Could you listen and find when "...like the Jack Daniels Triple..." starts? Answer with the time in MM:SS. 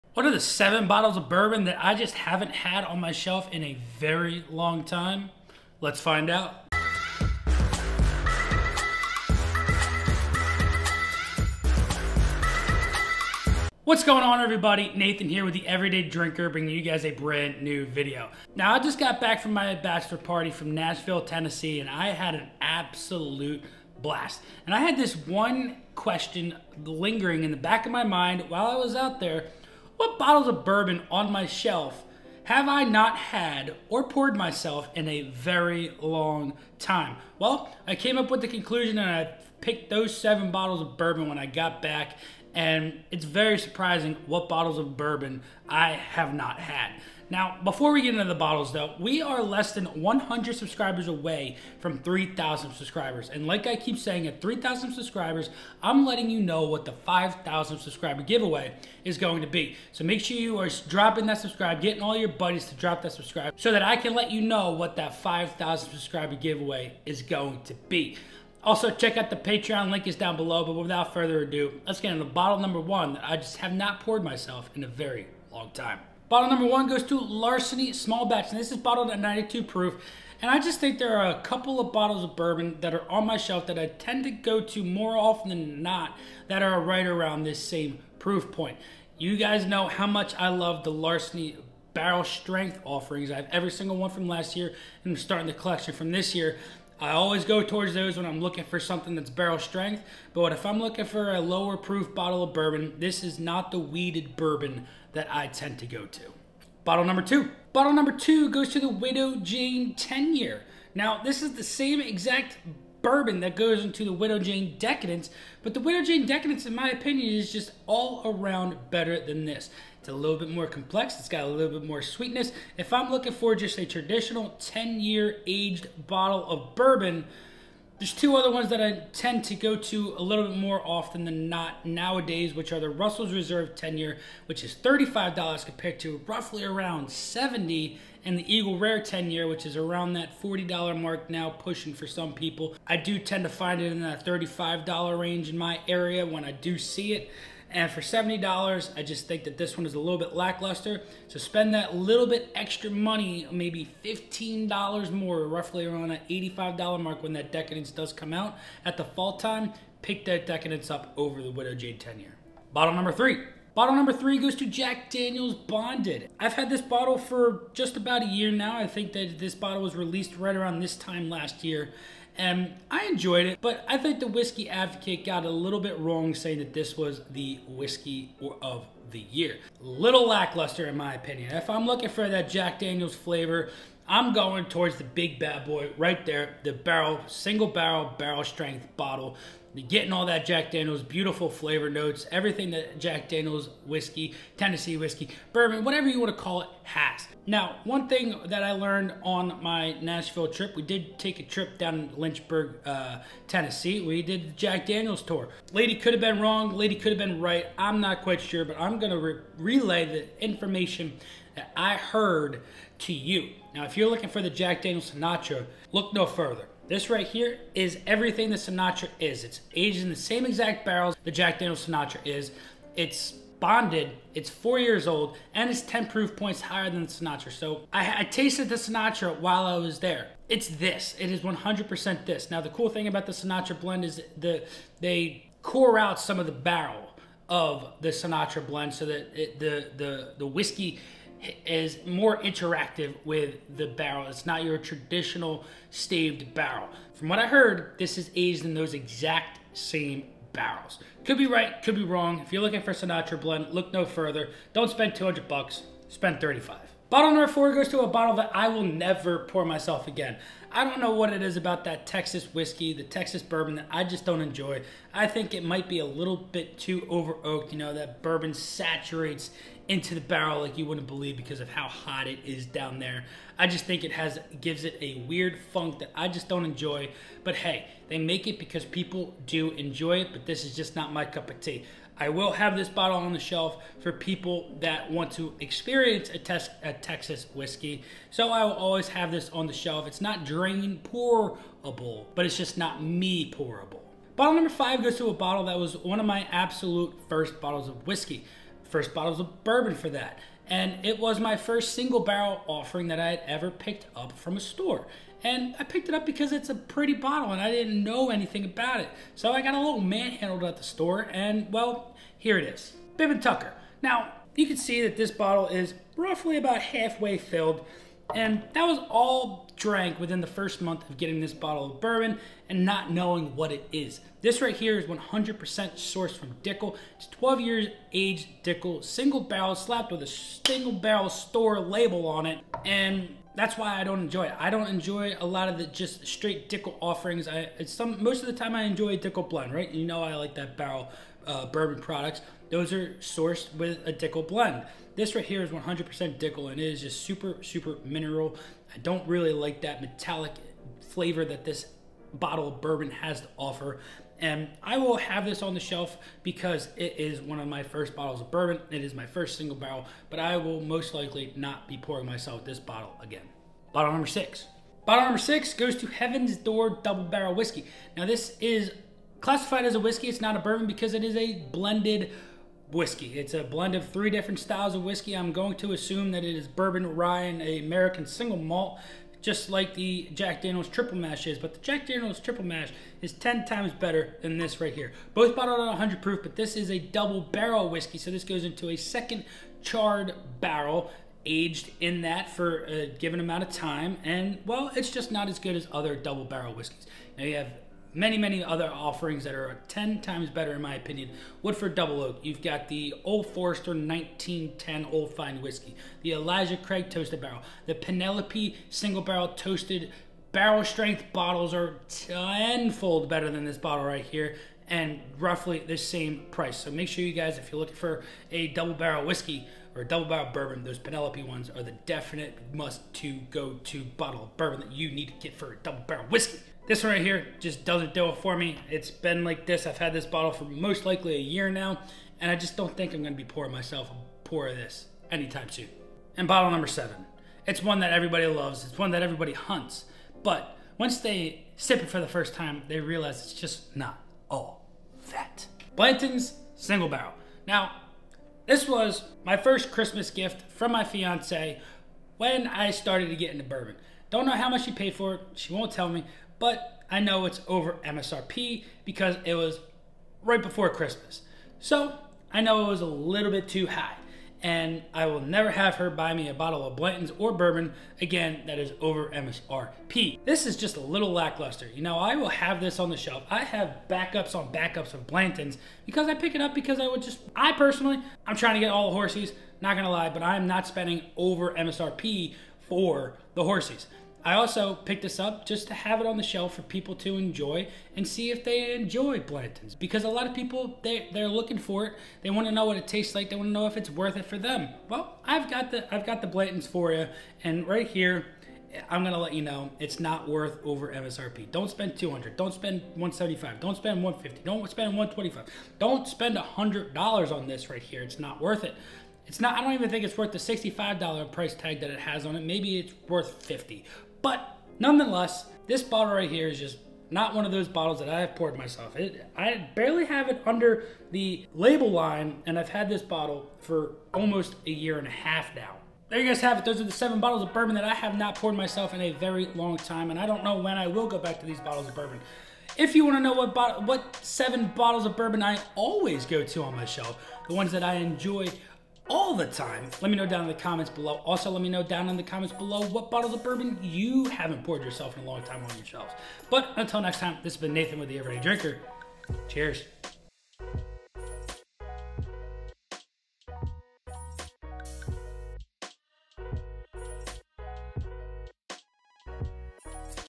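06:19.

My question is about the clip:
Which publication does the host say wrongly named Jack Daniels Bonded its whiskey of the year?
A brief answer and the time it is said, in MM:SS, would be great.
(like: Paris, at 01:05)
Whiskey Advocate, at 02:54.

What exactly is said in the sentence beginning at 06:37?
Now you have many, many other offerings that are 10 times better, in my opinion.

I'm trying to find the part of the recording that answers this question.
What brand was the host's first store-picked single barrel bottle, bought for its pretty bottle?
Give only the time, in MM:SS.
05:13.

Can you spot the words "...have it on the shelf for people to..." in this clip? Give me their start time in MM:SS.
08:05.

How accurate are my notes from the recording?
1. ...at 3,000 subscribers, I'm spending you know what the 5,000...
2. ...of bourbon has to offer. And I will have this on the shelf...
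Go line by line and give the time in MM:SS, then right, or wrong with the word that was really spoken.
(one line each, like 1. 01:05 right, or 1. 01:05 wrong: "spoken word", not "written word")
1. 00:54 wrong: "letting", not "spending"
2. 05:52 right.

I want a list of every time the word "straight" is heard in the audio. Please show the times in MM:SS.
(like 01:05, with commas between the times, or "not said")
05:36.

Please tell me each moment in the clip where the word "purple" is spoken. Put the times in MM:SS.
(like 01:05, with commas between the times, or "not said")
not said.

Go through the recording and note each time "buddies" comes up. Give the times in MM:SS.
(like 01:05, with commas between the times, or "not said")
01:02.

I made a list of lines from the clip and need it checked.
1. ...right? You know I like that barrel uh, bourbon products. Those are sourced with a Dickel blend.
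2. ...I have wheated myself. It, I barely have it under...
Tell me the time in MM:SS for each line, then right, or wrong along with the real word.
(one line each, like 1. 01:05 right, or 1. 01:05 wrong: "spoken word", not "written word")
1. 05:39 right
2. 08:38 wrong: "poured", not "wheated".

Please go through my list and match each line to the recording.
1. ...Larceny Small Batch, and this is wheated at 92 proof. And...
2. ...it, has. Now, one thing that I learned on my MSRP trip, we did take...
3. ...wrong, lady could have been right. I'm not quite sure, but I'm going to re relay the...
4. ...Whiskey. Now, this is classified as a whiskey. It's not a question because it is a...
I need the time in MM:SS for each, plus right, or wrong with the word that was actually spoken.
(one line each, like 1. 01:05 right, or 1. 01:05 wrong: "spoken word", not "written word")
1. 01:17 wrong: "bottled", not "wheated"
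2. 03:16 wrong: "Nashville", not "MSRP"
3. 03:26 right
4. 06:07 wrong: "bourbon", not "question".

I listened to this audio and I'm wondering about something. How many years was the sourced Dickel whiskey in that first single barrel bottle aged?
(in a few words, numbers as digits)
12.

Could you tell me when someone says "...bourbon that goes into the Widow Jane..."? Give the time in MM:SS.
01:53.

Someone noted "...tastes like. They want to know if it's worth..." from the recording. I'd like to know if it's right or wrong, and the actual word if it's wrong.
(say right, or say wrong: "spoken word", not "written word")
right.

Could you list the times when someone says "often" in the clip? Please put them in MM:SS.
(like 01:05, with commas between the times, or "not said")
01:25, 02:10.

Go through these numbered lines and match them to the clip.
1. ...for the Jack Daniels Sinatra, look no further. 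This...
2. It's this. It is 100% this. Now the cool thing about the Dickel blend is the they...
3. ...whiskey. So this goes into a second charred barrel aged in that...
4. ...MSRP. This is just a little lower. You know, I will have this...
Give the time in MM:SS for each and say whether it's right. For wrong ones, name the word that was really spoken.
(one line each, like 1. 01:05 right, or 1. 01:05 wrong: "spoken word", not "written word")
1. 03:34 right
2. 03:50 wrong: "Sinatra", not "Dickel"
3. 06:27 right
4. 07:49 wrong: "lackluster", not "lower".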